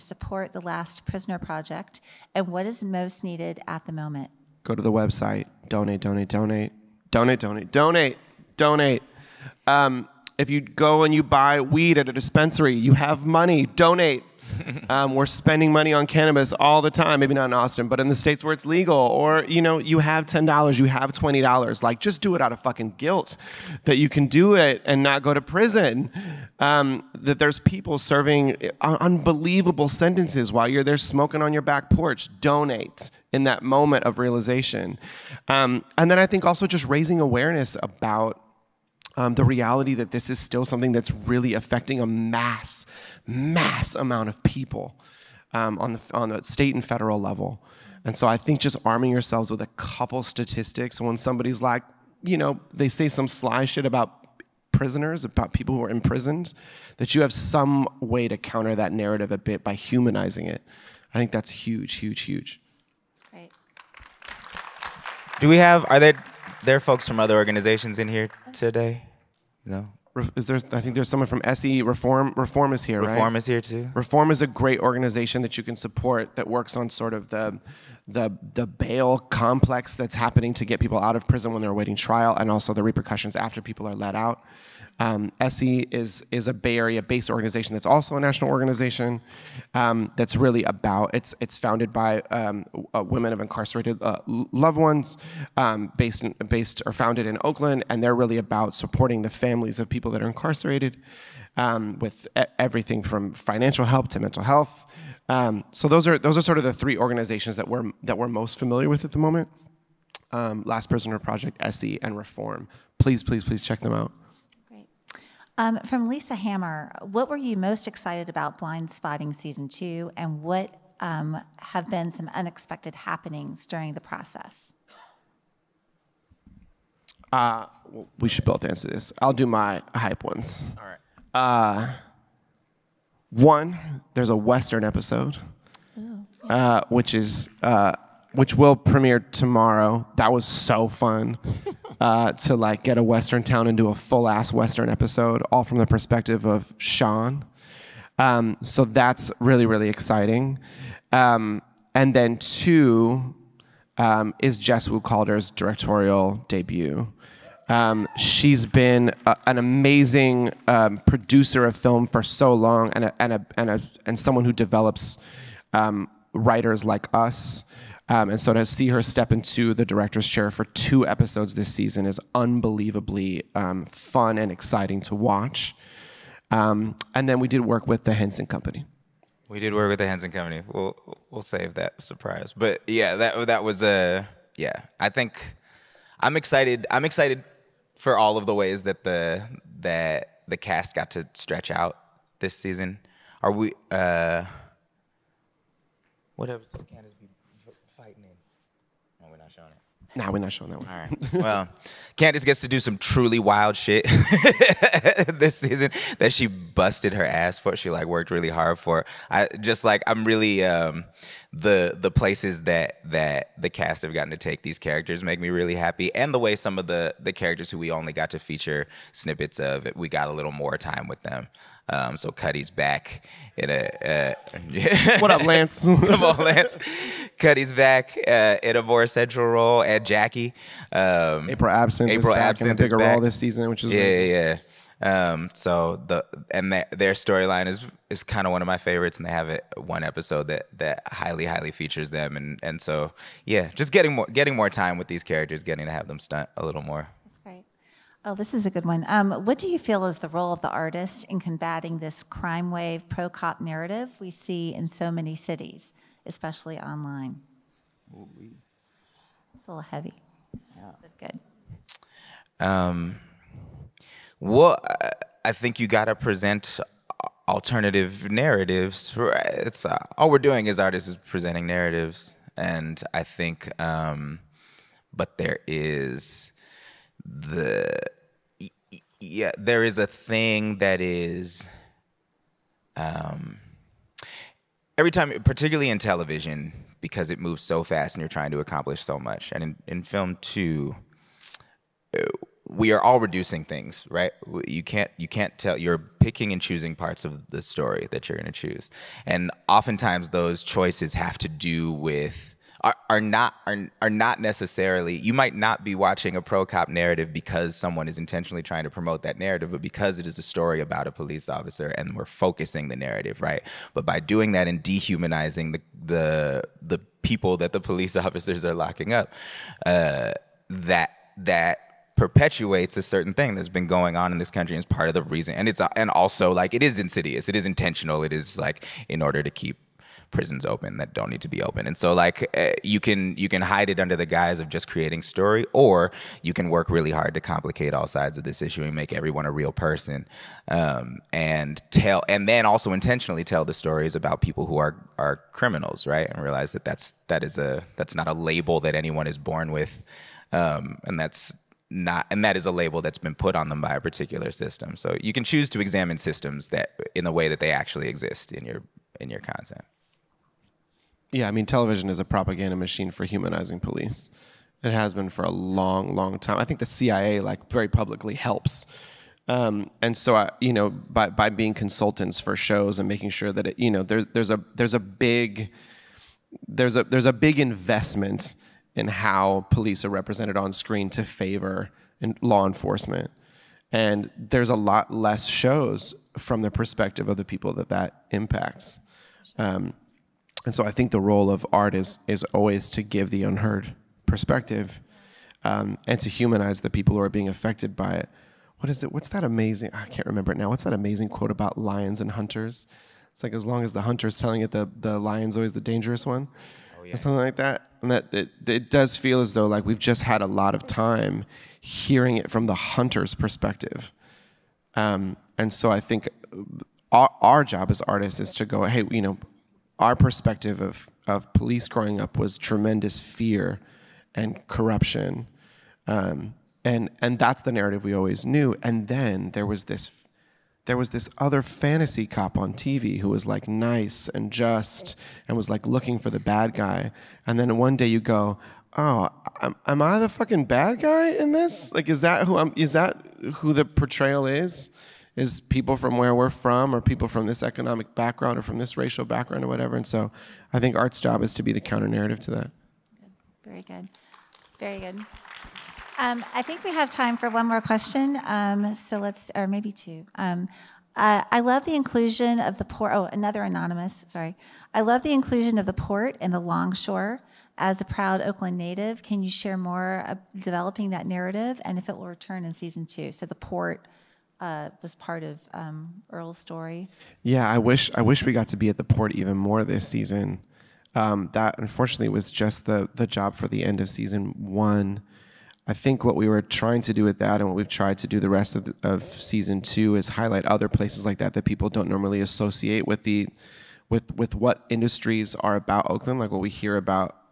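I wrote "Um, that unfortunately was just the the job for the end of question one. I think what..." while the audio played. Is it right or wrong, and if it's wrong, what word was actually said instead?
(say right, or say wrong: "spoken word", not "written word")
wrong: "season", not "question".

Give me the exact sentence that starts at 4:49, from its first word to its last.
And in, in film too, uh, we are all reducing things, right?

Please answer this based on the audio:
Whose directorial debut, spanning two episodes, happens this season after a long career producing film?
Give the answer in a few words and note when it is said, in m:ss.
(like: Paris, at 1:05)
Jess Wu Calder, at 2:34.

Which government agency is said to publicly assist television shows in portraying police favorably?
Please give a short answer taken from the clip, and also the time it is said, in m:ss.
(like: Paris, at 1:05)
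the CIA, at 6:06.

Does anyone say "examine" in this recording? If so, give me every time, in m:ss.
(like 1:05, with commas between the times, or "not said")
5:55.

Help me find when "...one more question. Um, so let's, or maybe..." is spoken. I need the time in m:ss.
7:37.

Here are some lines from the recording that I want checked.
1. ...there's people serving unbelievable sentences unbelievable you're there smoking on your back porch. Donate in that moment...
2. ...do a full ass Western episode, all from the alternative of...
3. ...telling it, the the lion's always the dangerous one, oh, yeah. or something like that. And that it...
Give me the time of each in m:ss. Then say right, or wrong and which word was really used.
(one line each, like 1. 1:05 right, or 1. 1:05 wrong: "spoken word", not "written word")
1. 0:27 wrong: "while", not "unbelievable"
2. 2:23 wrong: "perspective", not "alternative"
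3. 6:44 right.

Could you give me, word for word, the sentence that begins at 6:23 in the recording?
And there's a lot less shows from the perspective of the people that that impacts.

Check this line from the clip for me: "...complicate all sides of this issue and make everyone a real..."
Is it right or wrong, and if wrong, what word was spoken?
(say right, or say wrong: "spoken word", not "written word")
right.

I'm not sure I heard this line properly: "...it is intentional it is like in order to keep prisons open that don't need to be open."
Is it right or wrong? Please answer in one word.
right.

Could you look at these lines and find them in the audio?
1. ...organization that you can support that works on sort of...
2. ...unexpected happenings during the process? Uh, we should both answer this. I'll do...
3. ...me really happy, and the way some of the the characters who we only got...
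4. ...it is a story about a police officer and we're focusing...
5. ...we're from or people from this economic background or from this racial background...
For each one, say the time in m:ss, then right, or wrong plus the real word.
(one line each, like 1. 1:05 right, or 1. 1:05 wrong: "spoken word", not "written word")
1. 1:14 right
2. 2:02 right
3. 3:35 right
4. 5:10 right
5. 7:26 right.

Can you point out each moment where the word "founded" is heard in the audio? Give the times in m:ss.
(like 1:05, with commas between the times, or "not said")
1:31, 1:36.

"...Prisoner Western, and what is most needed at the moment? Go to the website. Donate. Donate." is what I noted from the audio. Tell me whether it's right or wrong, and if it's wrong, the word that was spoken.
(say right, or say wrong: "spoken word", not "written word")
wrong: "Project", not "Western".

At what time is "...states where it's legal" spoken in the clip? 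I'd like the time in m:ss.
0:18.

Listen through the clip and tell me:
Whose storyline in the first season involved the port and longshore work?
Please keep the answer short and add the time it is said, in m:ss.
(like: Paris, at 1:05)
Earl, at 7:56.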